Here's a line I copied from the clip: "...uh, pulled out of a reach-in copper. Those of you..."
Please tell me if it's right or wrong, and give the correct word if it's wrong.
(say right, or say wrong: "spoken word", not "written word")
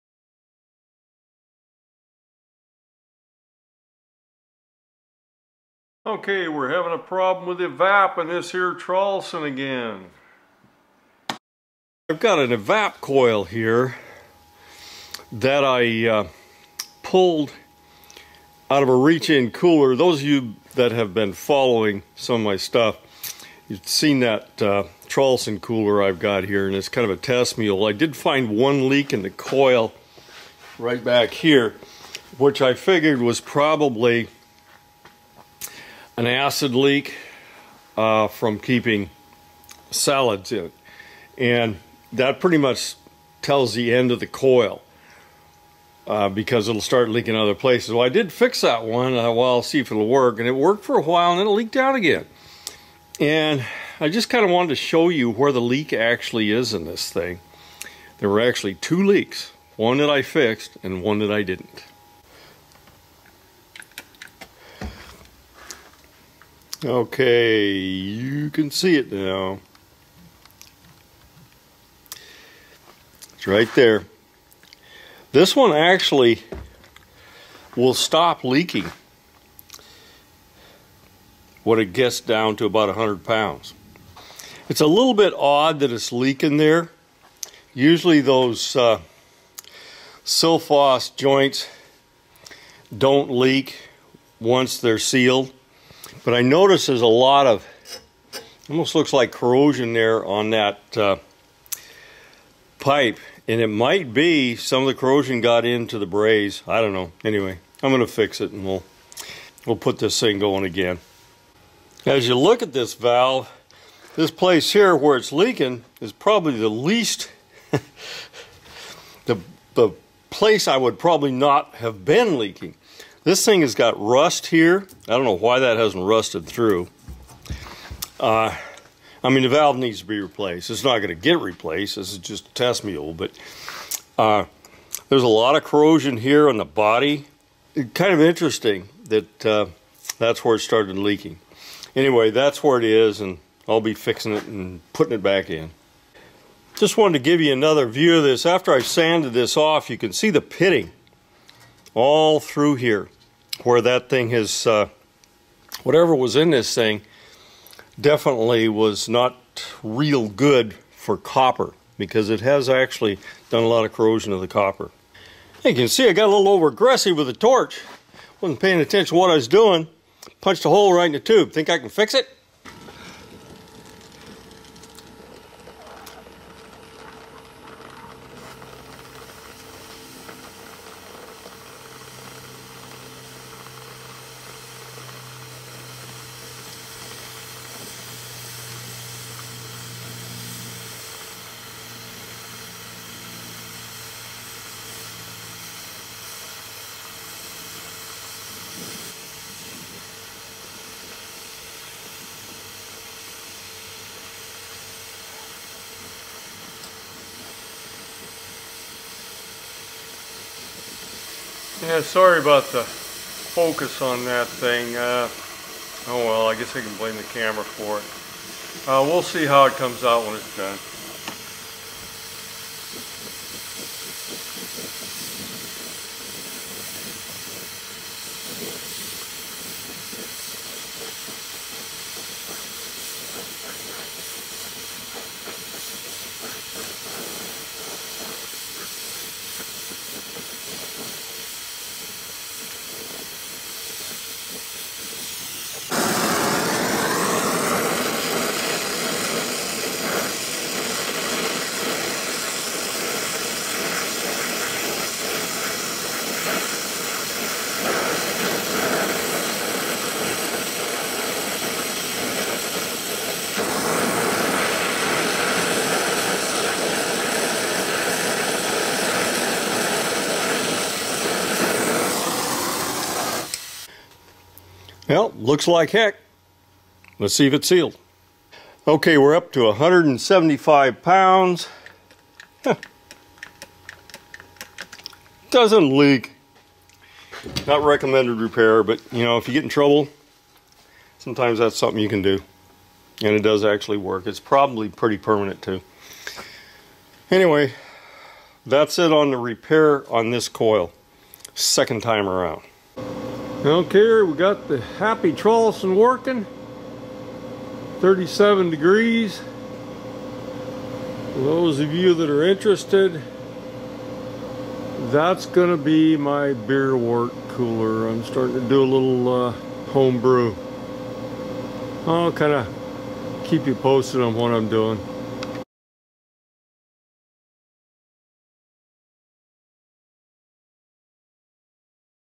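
wrong: "cooler", not "copper".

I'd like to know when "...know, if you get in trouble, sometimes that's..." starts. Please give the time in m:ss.
4:49.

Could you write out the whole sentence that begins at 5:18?
I'm starting to do a little uh, I'll kind of keep you posted on what I'm doing.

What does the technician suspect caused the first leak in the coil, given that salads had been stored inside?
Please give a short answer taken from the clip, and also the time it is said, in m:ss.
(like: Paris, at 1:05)
acid leak, at 0:36.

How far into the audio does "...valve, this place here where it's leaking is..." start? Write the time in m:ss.
1:52.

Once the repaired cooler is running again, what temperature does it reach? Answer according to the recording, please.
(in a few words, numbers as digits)
37 degrees.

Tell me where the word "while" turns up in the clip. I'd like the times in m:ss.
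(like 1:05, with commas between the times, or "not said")
0:51.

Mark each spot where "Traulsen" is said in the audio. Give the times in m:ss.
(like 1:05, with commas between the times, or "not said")
0:08, 0:25, 5:05.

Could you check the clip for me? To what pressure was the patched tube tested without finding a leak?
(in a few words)
175 pounds.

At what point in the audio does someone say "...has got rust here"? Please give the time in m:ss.
2:03.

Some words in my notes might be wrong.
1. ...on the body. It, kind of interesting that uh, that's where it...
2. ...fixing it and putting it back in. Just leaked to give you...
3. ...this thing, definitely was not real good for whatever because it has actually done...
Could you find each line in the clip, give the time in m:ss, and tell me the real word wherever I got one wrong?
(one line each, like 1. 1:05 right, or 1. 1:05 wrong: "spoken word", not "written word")
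1. 2:16 right
2. 2:23 wrong: "wanted", not "leaked"
3. 2:36 wrong: "copper", not "whatever".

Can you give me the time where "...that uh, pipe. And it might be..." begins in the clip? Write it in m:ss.
1:40.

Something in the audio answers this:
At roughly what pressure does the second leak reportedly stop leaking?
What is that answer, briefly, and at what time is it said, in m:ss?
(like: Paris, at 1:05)
100 pounds, at 1:22.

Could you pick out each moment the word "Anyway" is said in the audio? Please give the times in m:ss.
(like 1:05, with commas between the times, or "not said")
1:47, 2:21, 4:57.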